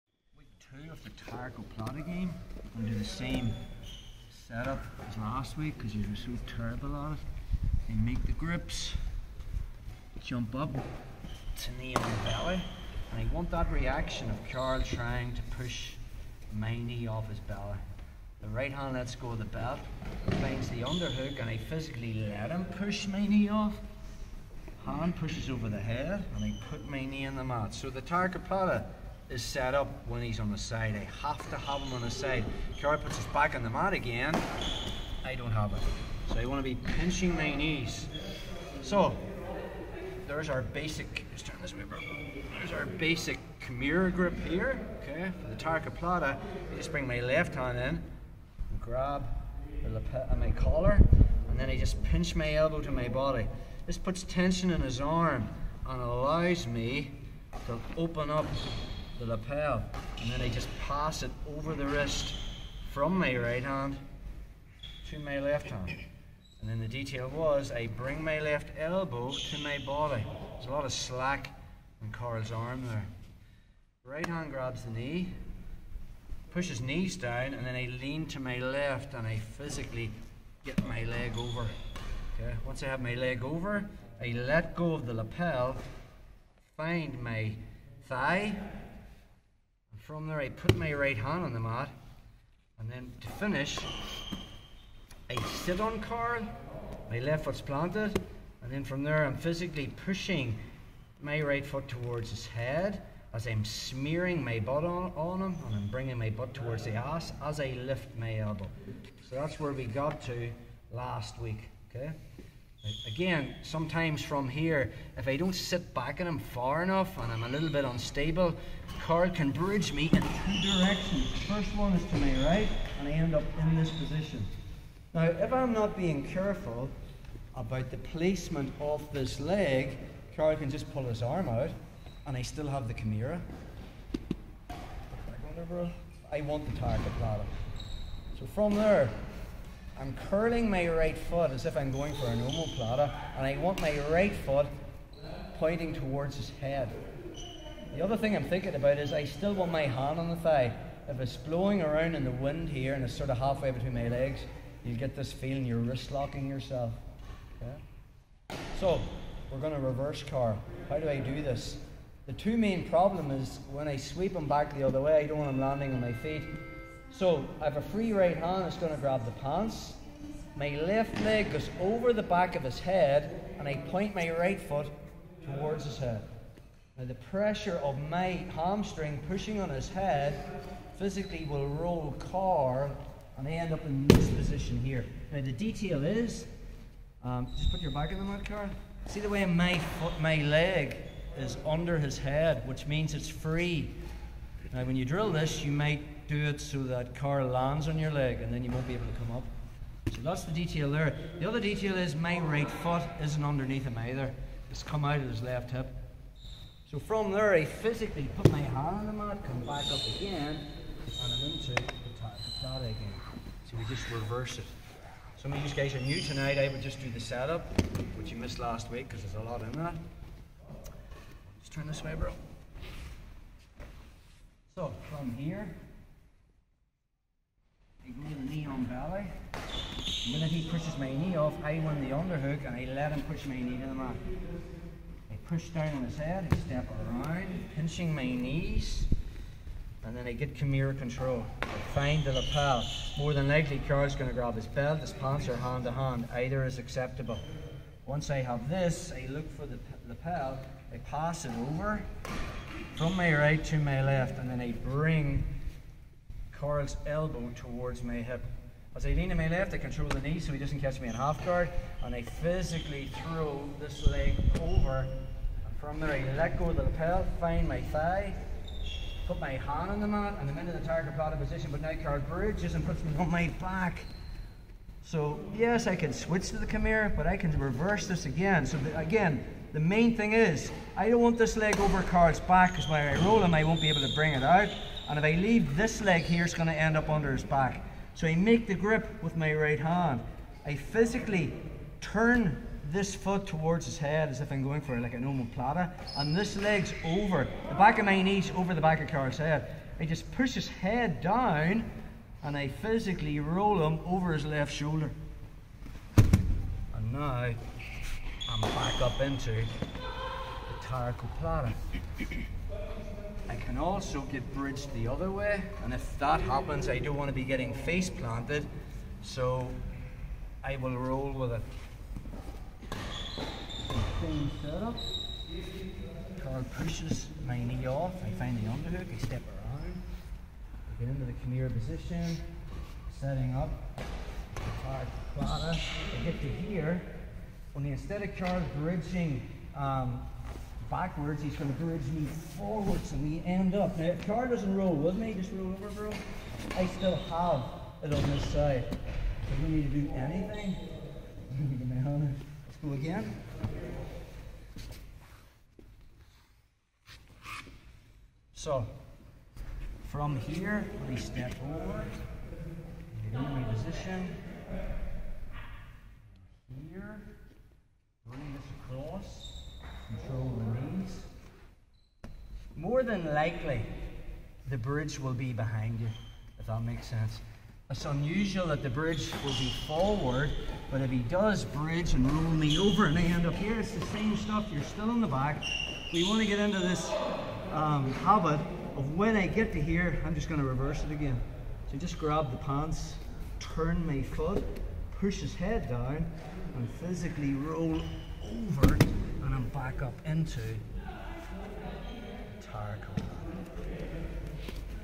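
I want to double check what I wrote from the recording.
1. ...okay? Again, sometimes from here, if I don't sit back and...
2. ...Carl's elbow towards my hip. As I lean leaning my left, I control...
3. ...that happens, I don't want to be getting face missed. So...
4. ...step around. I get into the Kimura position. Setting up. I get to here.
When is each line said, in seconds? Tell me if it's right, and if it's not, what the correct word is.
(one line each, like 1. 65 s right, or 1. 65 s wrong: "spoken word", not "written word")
1. 111 s right
2. 256 s right
3. 316 s wrong: "planted", not "missed"
4. 329 s right.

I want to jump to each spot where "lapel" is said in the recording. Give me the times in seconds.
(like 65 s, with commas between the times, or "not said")
49 s, 59 s, 85 s, 242 s, 250 s, 266 s.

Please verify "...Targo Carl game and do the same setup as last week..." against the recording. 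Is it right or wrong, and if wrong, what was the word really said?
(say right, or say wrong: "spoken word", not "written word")
wrong: "Plata", not "Carl".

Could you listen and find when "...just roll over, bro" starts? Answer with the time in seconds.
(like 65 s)
345 s.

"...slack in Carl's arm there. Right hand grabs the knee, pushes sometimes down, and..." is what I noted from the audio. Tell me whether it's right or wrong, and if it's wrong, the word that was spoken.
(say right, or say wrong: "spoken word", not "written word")
wrong: "knees", not "sometimes".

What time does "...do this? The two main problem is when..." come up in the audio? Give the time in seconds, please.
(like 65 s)
161 s.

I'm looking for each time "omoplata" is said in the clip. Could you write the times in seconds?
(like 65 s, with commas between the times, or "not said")
142 s, 295 s.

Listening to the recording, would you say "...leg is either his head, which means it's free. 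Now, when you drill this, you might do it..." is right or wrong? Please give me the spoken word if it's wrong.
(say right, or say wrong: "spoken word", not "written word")
wrong: "under", not "either".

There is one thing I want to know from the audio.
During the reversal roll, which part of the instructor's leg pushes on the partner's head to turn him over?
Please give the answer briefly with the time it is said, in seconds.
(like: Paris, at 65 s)
Hamstring, at 178 s.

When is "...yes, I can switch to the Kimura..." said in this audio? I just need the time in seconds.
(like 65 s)
275 s.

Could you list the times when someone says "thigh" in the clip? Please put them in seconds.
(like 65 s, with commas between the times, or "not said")
88 s, 150 s, 267 s.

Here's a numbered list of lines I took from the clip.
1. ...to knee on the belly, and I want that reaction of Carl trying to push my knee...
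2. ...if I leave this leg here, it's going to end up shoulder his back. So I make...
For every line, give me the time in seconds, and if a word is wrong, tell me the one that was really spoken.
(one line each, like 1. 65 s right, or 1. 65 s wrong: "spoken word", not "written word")
1. 10 s right
2. 285 s wrong: "under", not "shoulder".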